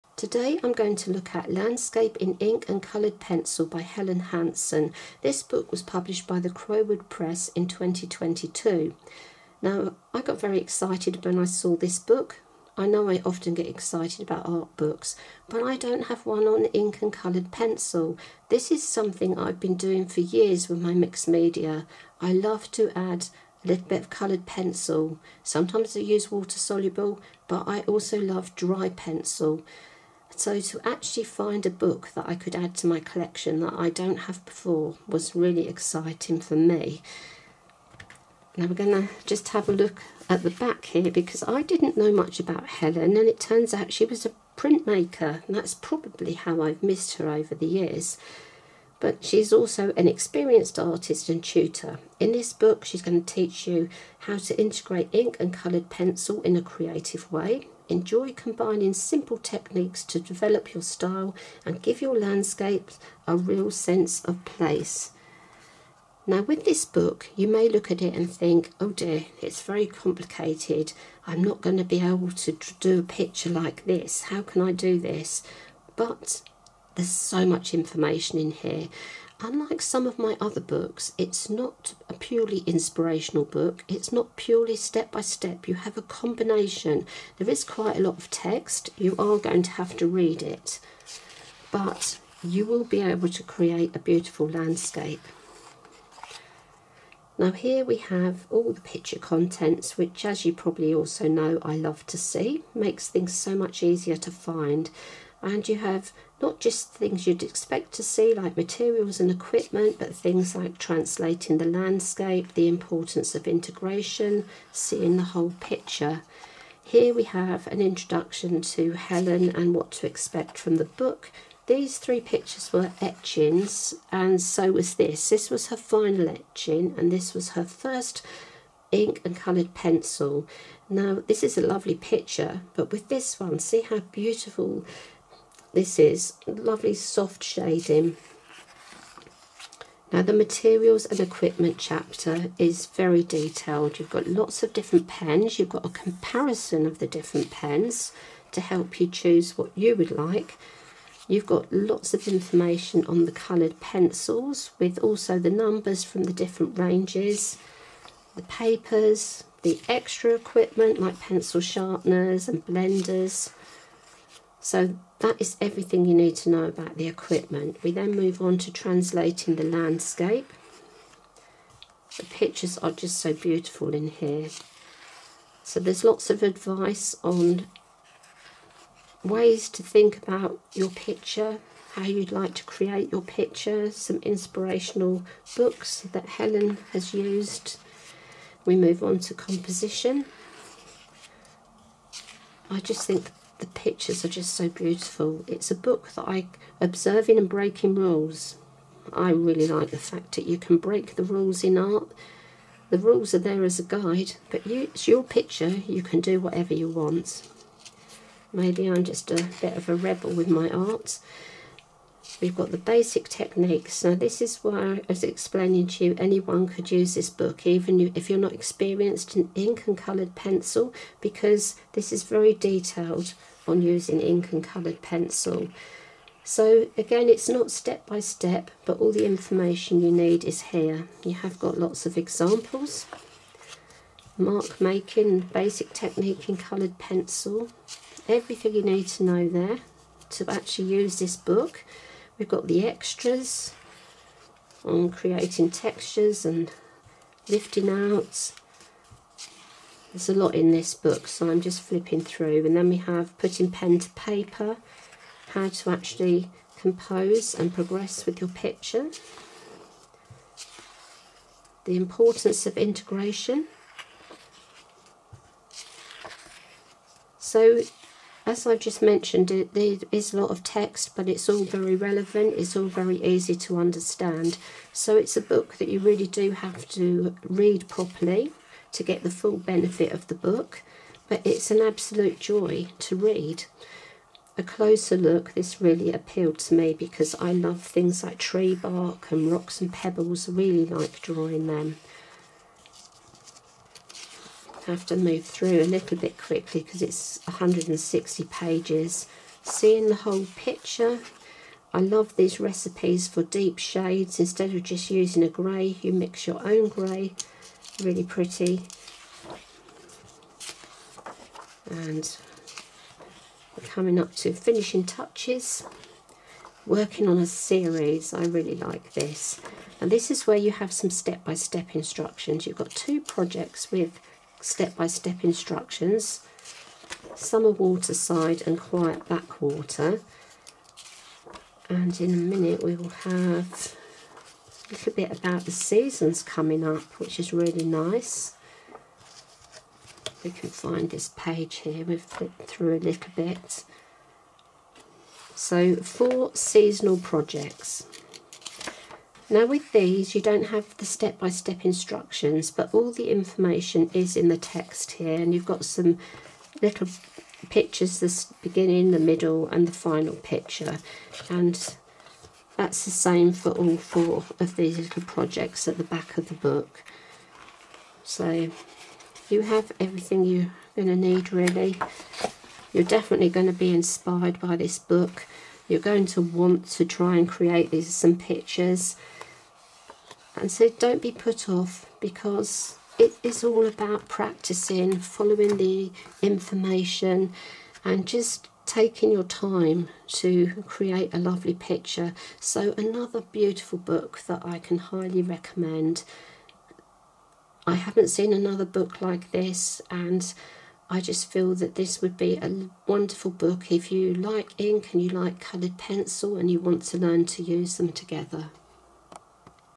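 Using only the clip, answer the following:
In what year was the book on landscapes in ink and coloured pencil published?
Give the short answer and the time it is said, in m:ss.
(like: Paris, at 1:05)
2022, at 0:07.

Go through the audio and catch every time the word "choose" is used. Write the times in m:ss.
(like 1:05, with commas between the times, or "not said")
2:29.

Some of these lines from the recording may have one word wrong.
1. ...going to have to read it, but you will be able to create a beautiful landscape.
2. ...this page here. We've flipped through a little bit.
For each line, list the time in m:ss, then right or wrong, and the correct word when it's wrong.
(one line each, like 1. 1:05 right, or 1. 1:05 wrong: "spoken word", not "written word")
1. 1:29 right
2. 5:41 right.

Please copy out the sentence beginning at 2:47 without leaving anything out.
We then move on to translating the landscape.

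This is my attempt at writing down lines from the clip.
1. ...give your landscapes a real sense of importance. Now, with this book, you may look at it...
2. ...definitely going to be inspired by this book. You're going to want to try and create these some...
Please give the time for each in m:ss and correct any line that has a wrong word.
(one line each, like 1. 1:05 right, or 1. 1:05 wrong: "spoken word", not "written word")
1. 1:01 wrong: "place", not "importance"
2. 6:13 right.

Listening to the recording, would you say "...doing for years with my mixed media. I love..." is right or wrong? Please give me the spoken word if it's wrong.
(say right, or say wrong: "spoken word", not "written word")
right.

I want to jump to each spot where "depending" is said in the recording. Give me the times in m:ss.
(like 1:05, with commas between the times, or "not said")
not said.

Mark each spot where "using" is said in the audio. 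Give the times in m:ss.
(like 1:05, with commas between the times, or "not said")
3:43, 5:05.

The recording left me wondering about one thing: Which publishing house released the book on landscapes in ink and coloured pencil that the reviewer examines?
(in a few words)
Crowood Press.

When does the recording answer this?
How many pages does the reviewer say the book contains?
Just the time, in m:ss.
4:57.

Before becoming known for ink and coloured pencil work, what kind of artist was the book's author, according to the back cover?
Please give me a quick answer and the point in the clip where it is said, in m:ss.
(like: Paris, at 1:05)
printmaker, at 0:44.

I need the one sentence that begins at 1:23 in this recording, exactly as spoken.
It's not purely step by step.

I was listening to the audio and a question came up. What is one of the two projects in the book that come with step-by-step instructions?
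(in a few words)
Summer waterside.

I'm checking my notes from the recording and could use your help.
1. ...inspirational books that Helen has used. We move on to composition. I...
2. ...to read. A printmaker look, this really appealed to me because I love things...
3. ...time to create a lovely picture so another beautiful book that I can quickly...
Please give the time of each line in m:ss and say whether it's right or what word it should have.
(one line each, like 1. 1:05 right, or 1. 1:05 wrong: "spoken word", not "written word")
1. 3:04 right
2. 4:42 wrong: "closer", not "printmaker"
3. 6:29 wrong: "highly", not "quickly".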